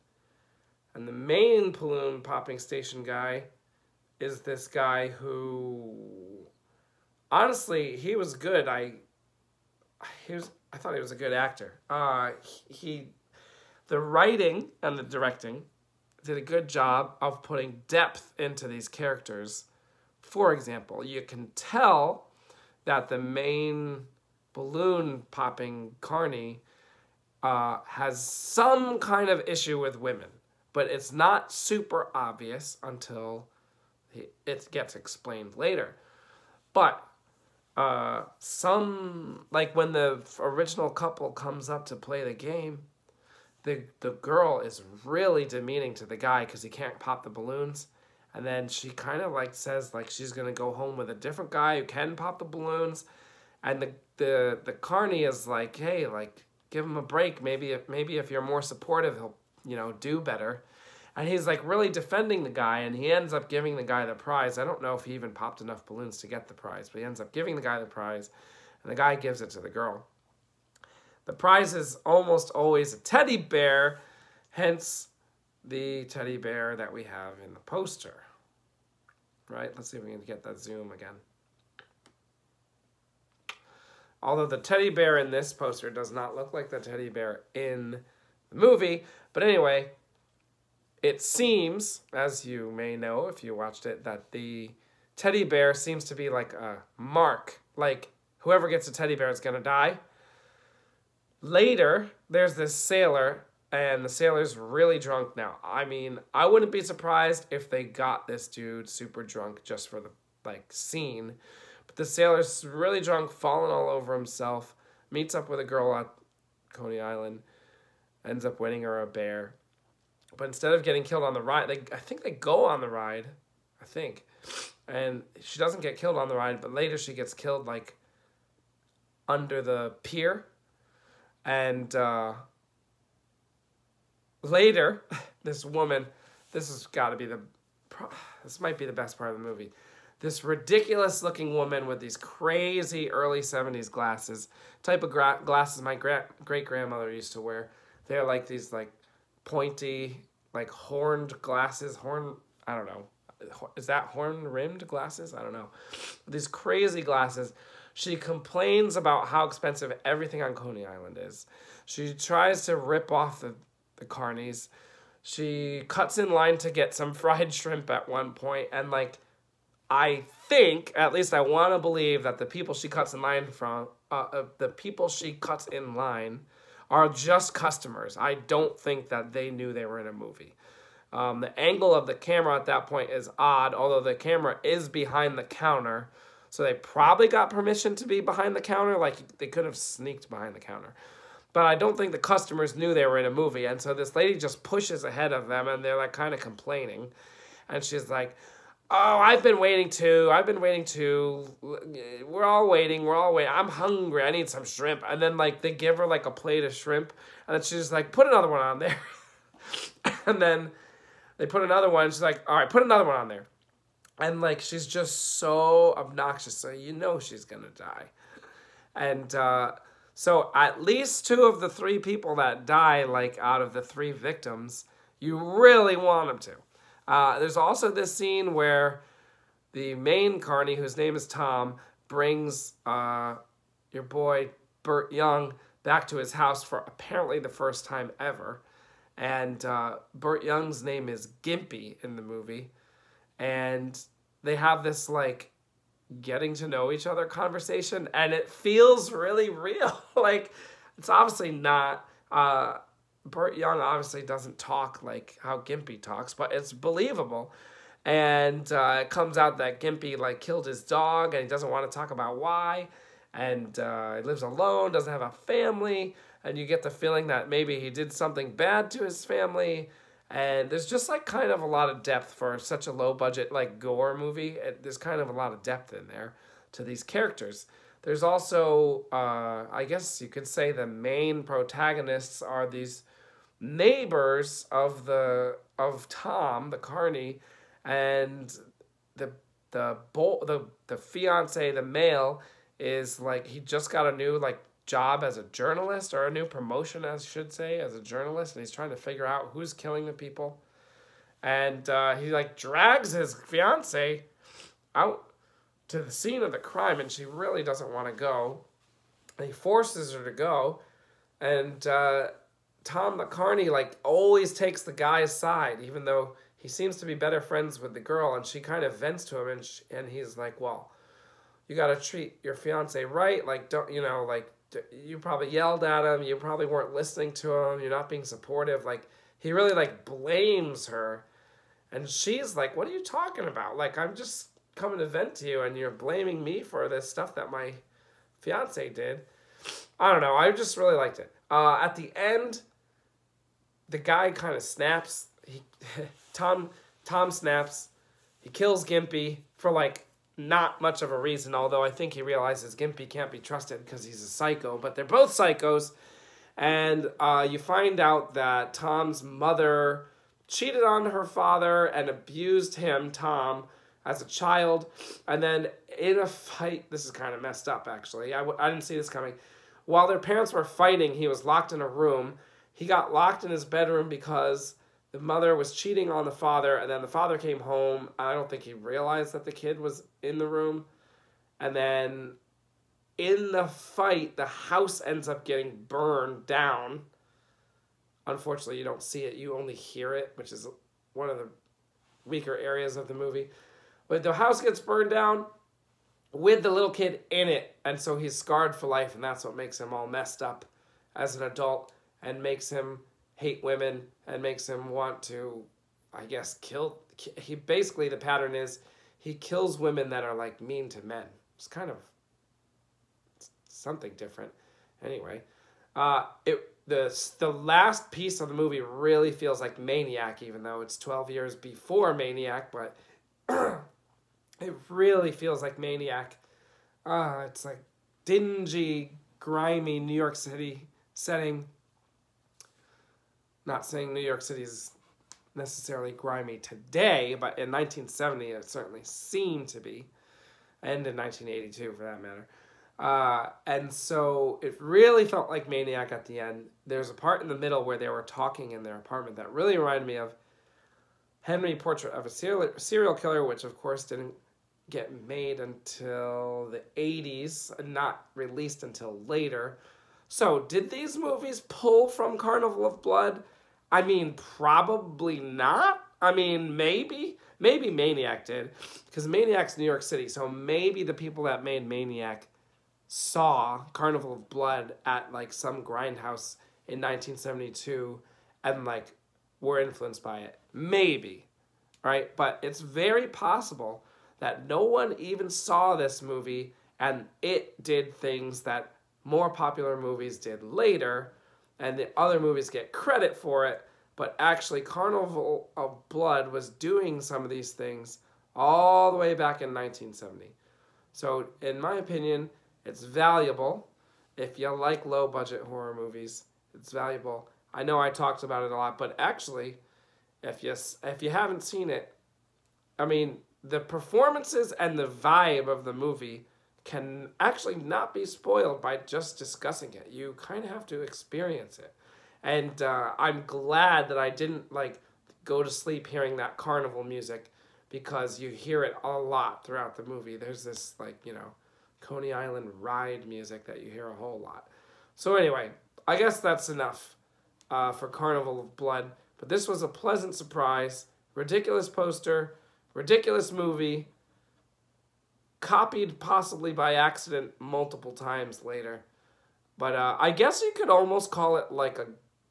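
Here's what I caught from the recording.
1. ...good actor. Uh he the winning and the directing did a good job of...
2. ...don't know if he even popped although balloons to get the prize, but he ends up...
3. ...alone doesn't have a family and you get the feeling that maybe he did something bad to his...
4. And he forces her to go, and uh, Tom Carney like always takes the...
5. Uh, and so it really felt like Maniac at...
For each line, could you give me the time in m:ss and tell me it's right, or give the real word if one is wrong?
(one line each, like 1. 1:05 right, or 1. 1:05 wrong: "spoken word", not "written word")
1. 0:11 wrong: "writing", not "winning"
2. 1:04 wrong: "enough", not "although"
3. 4:24 right
4. 5:09 wrong: "McCarney", not "Carney"
5. 7:22 right.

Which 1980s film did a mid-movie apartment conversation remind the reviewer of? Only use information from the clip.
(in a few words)
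Henry: Portrait of a Serial Killer.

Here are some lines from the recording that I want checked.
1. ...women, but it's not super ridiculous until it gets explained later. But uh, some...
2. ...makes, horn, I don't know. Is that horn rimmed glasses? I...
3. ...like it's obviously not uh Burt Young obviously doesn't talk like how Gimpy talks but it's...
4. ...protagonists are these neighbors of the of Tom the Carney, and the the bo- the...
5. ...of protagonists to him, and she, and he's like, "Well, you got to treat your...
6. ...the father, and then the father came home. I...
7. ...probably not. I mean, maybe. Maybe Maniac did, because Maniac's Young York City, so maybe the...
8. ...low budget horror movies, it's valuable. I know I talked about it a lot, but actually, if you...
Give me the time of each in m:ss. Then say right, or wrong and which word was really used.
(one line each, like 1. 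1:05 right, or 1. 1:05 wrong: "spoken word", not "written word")
1. 0:30 wrong: "obvious", not "ridiculous"
2. 2:31 wrong: "glasses", not "makes"
3. 4:10 right
4. 4:41 right
5. 5:18 wrong: "vents", not "protagonists"
6. 6:16 right
7. 7:44 wrong: "New", not "Young"
8. 8:25 right.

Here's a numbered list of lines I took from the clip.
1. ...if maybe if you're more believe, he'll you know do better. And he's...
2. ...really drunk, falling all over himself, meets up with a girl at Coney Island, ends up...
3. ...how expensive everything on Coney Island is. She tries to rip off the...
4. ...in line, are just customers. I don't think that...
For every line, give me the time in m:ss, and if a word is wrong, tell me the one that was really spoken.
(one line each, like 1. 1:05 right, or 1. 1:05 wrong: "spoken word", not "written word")
1. 0:57 wrong: "supportive", not "believe"
2. 1:52 right
3. 2:39 right
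4. 2:55 right.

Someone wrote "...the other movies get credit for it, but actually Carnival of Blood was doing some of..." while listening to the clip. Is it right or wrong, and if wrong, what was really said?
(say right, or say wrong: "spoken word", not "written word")
right.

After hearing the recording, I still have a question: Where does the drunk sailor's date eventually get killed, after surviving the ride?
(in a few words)
Under the pier.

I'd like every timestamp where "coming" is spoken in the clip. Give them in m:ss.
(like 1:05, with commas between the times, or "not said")
5:34, 6:09.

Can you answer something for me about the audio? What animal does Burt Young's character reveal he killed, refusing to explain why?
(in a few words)
His dog.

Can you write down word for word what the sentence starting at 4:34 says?
There's kind of a lot of depth in there to these characters.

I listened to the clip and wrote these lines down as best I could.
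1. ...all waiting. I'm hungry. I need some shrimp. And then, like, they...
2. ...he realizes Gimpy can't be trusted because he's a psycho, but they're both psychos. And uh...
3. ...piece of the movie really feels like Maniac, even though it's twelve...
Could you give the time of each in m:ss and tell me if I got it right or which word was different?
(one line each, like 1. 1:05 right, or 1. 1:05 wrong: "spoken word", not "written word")
1. 3:23 right
2. 5:52 right
3. 6:58 right.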